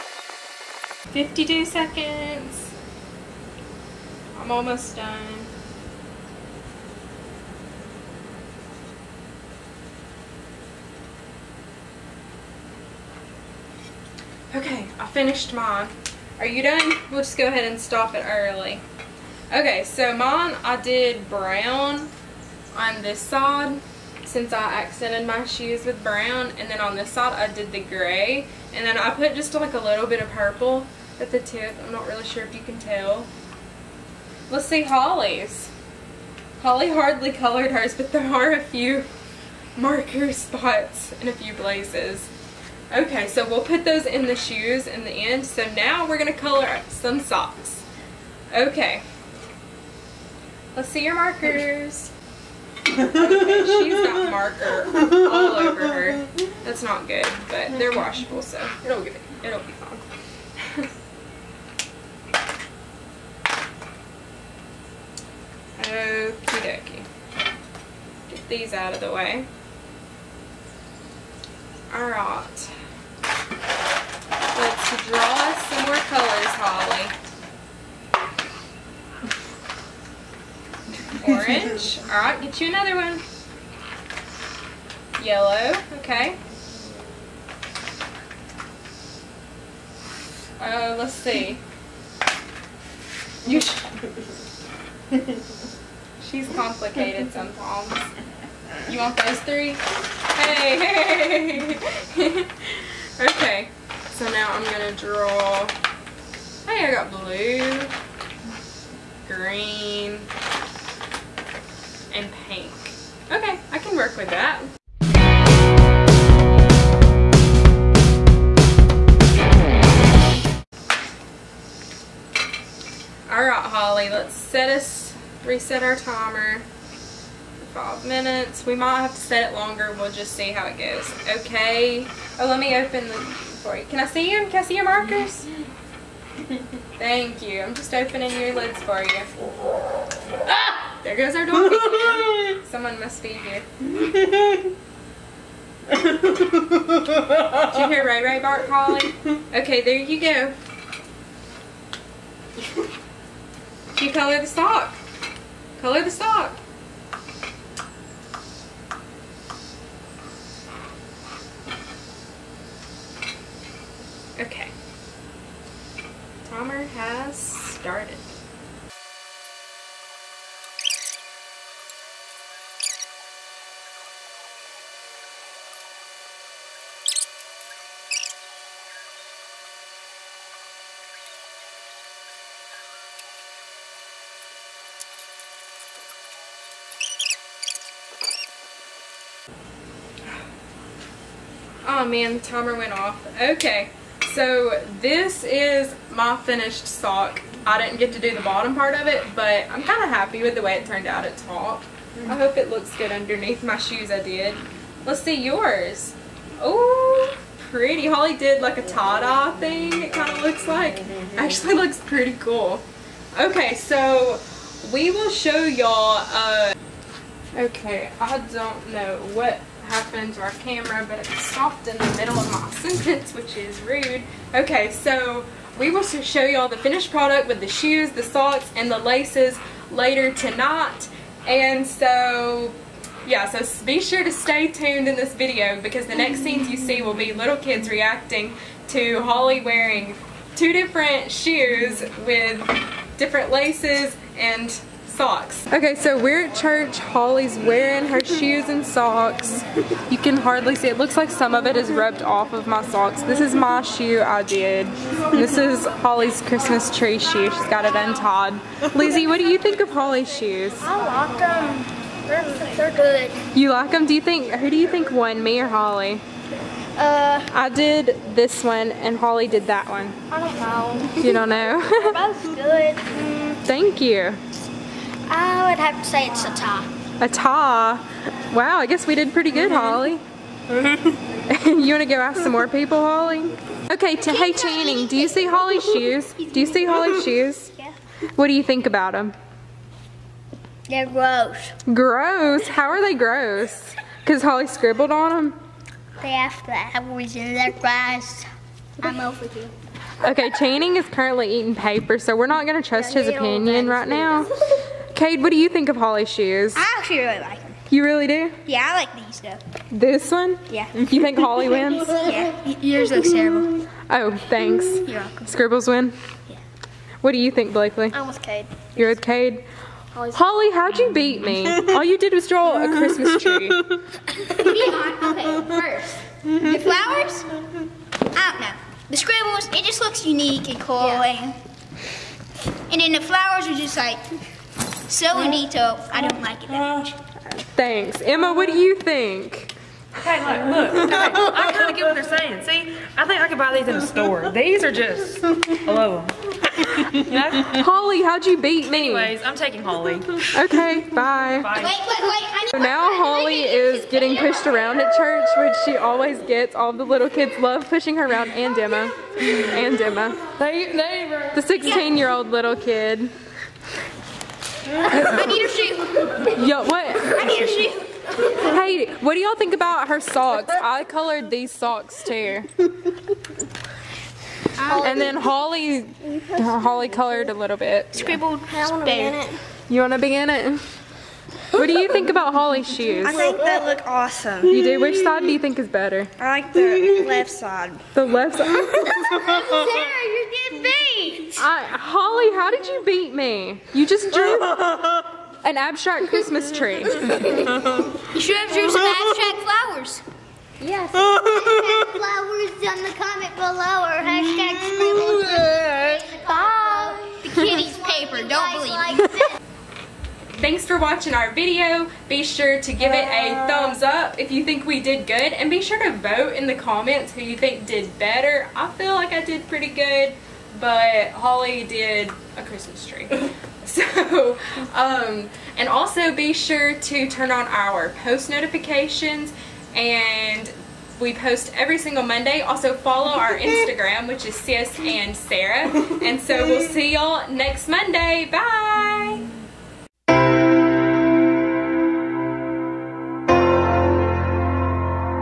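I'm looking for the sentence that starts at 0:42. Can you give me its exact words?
Okay, so we'll put those in the shoes in the end.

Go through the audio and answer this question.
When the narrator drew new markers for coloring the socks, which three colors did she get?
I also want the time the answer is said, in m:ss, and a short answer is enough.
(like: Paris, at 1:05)
blue, green, and pink, at 1:47.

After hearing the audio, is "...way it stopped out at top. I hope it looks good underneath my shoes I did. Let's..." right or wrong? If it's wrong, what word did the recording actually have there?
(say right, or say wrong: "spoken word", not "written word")
wrong: "turned", not "stopped".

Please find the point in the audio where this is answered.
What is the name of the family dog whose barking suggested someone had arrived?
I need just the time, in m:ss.
2:28.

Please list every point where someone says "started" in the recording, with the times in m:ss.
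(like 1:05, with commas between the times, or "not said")
2:47.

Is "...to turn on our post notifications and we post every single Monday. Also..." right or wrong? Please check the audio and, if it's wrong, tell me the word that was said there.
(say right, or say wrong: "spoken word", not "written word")
right.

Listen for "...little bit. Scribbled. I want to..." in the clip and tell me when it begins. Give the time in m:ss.
6:17.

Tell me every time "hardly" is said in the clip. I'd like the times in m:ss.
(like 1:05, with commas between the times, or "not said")
0:36, 4:10.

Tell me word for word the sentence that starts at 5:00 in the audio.
Okay, Channing is currently eating paper, so we're not going to trust his opinion right now.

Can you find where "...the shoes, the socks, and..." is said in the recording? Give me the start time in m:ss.
3:47.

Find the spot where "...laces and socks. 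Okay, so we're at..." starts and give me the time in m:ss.
4:03.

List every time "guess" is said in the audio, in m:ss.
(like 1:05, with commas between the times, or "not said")
4:38.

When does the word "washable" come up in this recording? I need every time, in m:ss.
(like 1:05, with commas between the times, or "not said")
0:57.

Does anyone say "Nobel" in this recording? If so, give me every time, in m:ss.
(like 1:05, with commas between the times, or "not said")
not said.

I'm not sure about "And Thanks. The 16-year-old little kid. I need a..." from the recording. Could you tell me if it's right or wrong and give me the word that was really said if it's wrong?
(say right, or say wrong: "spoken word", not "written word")
wrong: "Emma", not "Thanks".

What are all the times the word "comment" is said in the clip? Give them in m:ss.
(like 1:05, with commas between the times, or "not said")
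6:43, 6:56.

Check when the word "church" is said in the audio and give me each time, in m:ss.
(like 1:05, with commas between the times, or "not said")
4:06, 5:55.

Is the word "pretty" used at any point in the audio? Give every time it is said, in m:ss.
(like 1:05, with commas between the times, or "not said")
3:27, 3:32, 4:39, 6:59.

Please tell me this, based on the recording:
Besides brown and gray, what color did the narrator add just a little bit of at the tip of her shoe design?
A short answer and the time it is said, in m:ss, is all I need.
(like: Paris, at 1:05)
purple, at 0:30.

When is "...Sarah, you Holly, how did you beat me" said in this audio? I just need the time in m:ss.
6:28.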